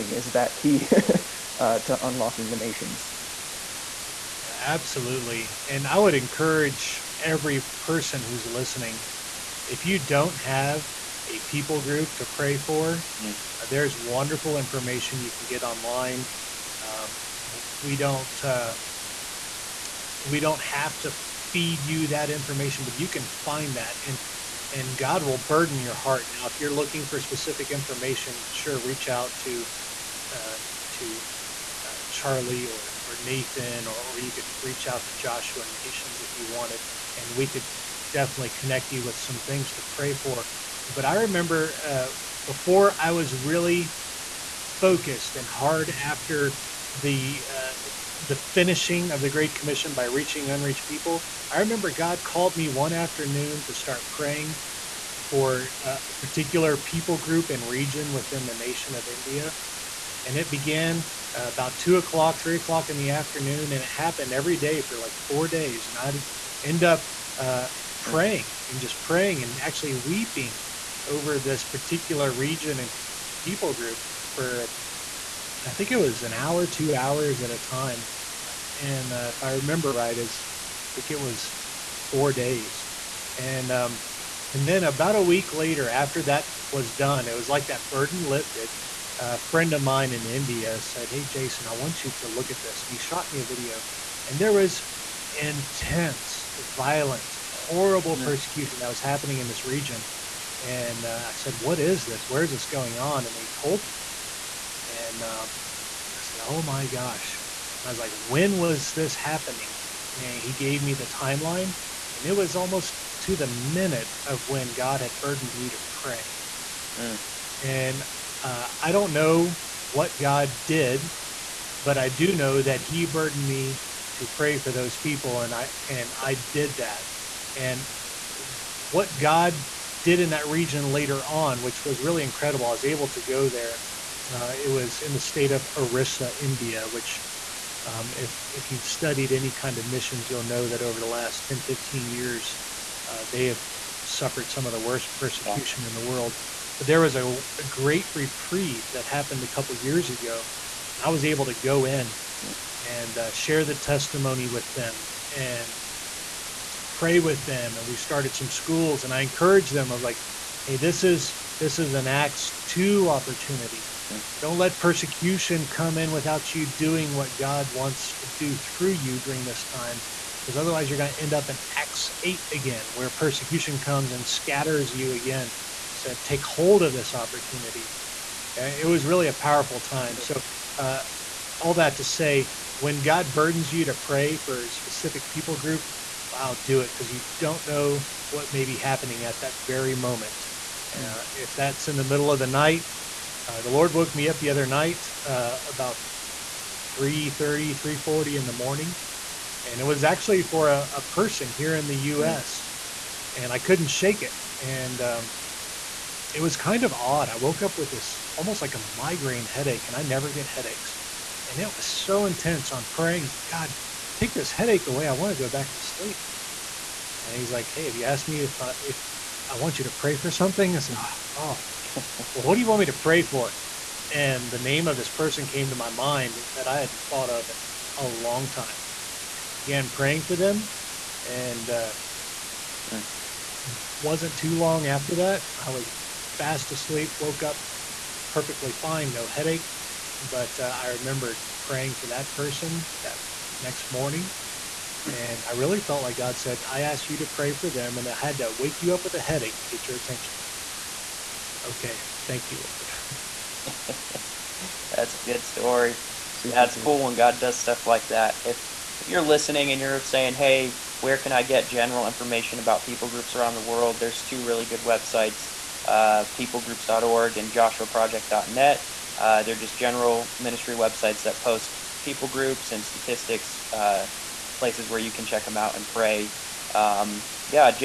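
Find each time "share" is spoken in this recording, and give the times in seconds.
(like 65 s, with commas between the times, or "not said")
153 s.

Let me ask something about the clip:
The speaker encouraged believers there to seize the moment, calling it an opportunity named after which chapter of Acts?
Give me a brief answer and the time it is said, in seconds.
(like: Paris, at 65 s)
Acts 2, at 162 s.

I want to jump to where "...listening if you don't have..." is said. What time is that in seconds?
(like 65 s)
8 s.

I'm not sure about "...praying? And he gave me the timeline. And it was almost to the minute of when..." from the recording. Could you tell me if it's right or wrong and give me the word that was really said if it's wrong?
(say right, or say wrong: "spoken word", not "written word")
wrong: "happening", not "praying".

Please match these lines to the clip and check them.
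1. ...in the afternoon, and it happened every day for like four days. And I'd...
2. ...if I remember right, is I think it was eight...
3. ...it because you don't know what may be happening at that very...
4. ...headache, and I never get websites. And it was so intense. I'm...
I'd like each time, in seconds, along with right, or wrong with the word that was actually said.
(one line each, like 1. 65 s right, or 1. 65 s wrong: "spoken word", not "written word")
1. 62 s right
2. 79 s wrong: "four", not "eight"
3. 186 s right
4. 209 s wrong: "headaches", not "websites".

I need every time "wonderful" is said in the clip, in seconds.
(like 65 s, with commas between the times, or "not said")
13 s.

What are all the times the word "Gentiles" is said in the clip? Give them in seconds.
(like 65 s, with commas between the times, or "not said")
not said.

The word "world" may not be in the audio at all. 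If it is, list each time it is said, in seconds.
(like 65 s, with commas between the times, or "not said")
146 s, 263 s.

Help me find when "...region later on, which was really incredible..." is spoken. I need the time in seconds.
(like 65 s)
130 s.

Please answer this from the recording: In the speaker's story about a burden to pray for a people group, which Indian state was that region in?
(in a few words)
Orissa.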